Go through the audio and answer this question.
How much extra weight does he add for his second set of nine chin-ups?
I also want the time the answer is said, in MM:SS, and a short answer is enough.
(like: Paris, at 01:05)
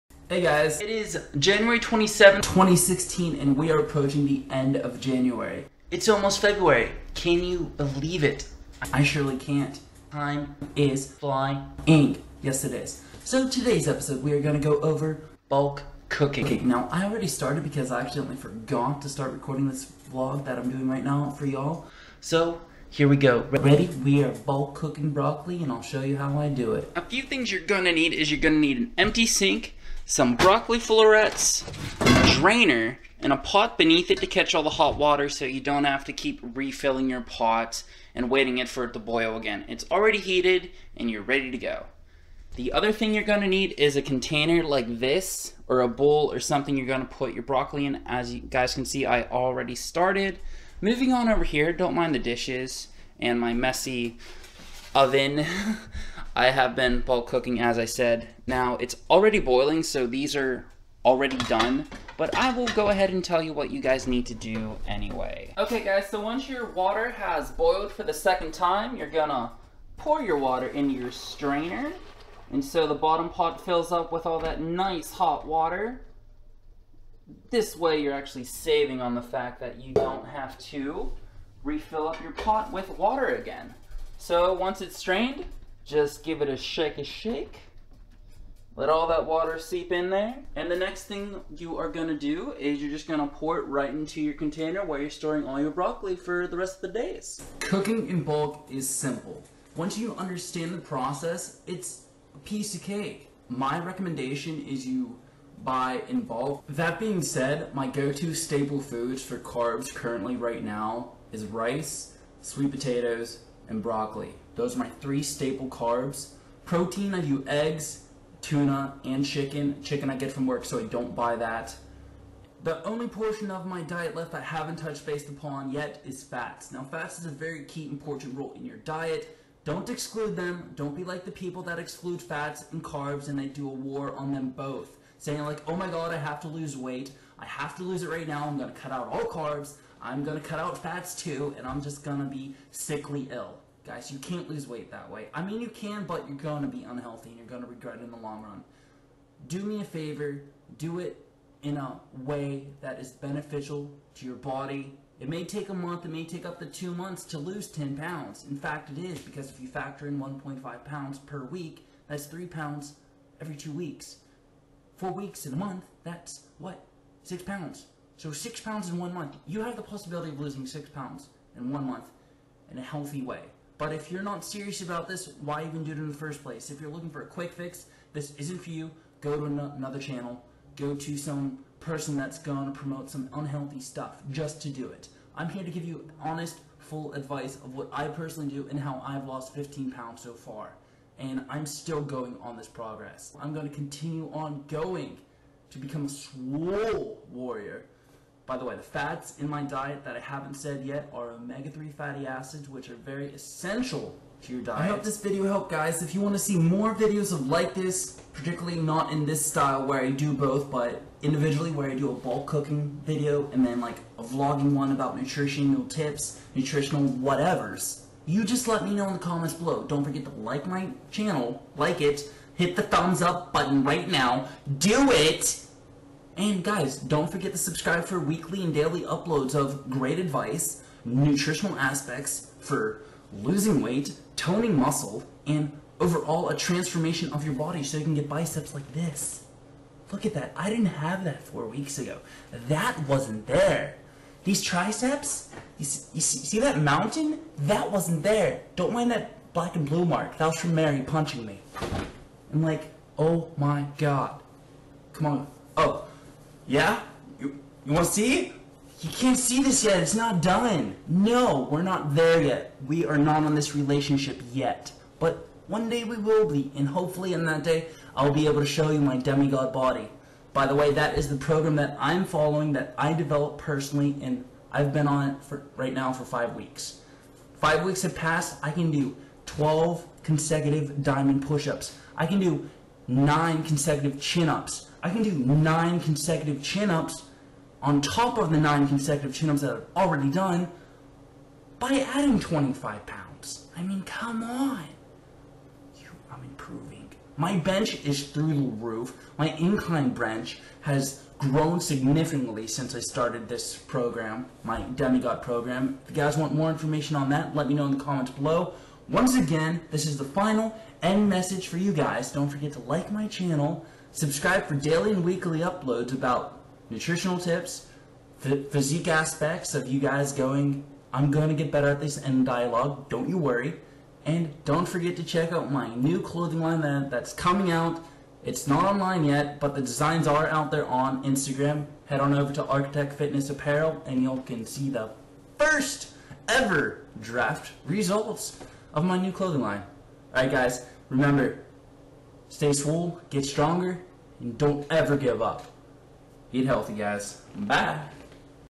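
25 pounds, at 04:52.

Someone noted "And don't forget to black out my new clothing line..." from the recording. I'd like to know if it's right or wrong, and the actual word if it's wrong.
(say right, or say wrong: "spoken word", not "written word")
wrong: "check", not "black".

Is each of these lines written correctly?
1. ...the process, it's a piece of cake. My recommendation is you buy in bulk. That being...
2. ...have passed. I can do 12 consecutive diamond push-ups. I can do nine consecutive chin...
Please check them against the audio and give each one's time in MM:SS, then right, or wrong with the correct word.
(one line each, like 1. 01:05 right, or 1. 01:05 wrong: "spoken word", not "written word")
1. 01:40 right
2. 04:38 right.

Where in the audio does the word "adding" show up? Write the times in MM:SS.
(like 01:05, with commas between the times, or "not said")
04:52.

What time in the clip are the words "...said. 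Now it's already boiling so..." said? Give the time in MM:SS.
00:57.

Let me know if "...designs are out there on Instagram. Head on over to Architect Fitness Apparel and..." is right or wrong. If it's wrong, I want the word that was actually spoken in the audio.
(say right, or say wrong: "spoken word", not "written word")
right.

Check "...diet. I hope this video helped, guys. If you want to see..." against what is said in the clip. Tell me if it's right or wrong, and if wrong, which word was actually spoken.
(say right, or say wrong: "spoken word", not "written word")
right.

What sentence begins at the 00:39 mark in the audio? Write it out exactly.
It's already heated and you're ready to go.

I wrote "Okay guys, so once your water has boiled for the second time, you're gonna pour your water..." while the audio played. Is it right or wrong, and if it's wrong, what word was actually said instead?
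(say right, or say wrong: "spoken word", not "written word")
right.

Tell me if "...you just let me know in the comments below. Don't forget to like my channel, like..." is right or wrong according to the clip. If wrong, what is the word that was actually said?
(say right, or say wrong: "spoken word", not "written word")
right.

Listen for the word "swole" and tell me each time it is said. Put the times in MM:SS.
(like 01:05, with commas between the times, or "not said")
03:16, 05:42.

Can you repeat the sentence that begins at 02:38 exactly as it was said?
In fact, it is because if you factor in 1.5 pounds per week, that's three pounds every two weeks.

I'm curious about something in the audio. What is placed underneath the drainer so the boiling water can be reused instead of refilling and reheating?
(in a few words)
a pot.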